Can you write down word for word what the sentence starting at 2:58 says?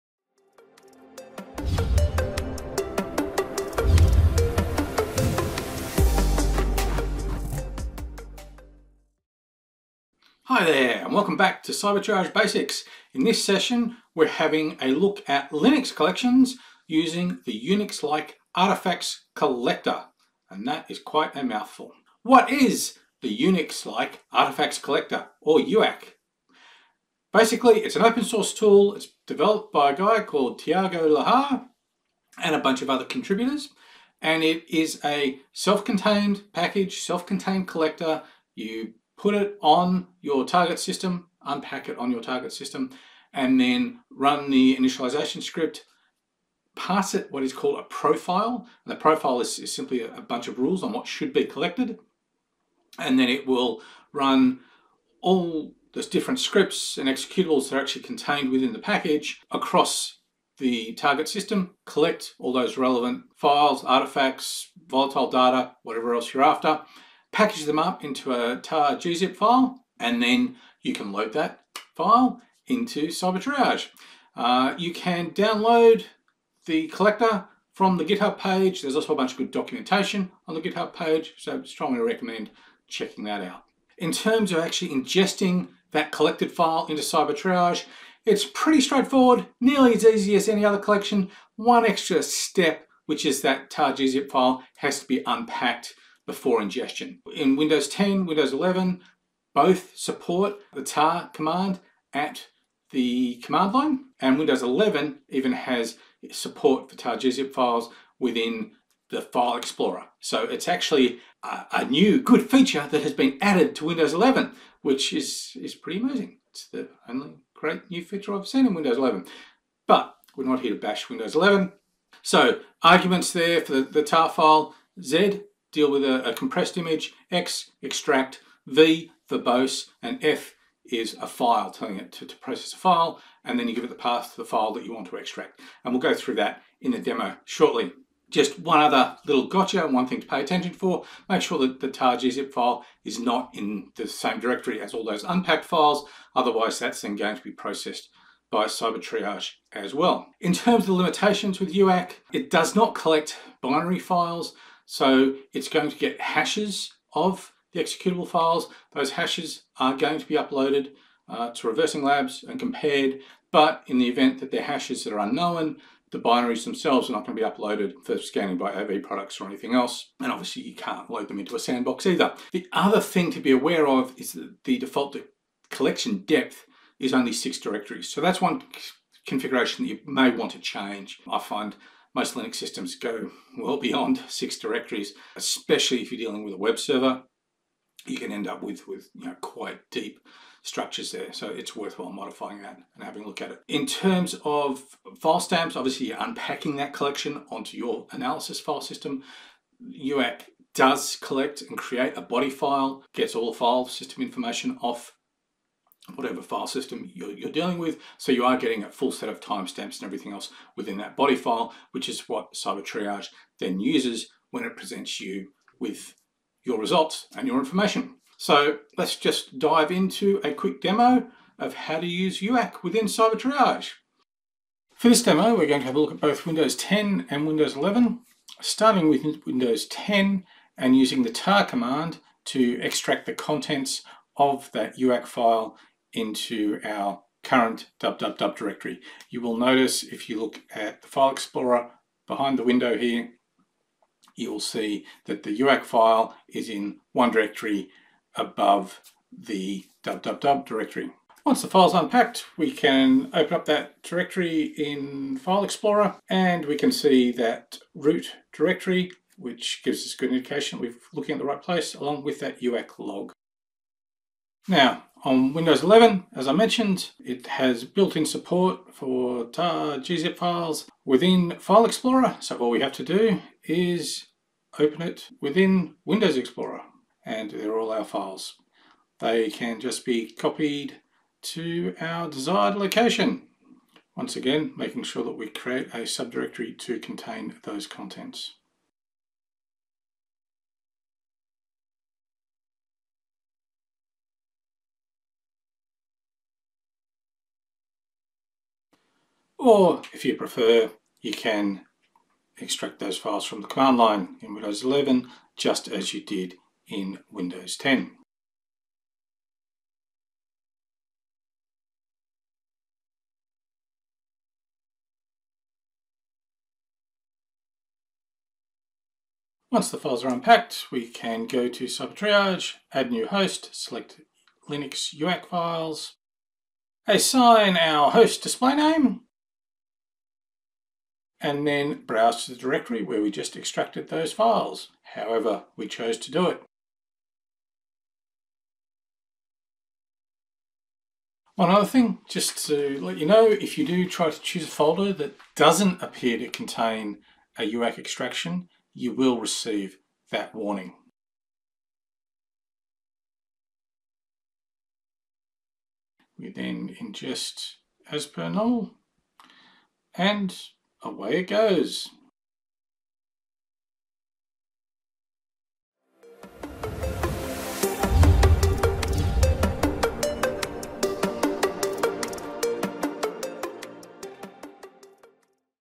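So that's one configuration that you may want to change.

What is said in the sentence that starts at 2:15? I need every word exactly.
And we'll go through that in the demo shortly.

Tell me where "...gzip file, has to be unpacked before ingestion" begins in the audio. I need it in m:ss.
1:33.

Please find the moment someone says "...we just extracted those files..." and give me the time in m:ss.
5:33.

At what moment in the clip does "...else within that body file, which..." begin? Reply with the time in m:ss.
3:30.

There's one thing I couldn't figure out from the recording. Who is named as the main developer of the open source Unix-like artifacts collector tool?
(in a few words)
Thiago Lahr.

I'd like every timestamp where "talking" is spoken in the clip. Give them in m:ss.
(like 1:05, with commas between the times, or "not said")
not said.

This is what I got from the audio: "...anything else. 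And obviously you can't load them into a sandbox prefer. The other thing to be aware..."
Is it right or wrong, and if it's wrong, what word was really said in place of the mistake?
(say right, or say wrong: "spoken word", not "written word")
wrong: "either", not "prefer".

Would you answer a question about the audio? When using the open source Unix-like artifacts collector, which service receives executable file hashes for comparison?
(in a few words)
ReversingLabs.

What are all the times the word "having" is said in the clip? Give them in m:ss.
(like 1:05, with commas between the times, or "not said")
0:14, 3:13.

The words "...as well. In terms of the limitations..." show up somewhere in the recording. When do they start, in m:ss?
2:29.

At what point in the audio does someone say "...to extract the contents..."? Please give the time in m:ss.
3:52.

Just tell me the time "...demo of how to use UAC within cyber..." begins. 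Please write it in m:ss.
3:40.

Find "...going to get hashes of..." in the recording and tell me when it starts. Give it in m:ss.
2:35.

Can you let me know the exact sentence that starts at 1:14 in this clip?
Uh, you can download the collector from the GitHub page.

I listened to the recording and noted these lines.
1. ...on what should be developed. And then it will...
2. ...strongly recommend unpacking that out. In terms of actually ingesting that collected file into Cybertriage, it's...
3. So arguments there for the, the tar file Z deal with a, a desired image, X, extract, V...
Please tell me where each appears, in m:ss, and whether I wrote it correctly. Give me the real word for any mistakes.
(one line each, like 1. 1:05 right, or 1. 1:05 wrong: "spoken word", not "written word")
1. 0:50 wrong: "collected", not "developed"
2. 1:21 wrong: "checking", not "unpacking"
3. 2:02 wrong: "compressed", not "desired".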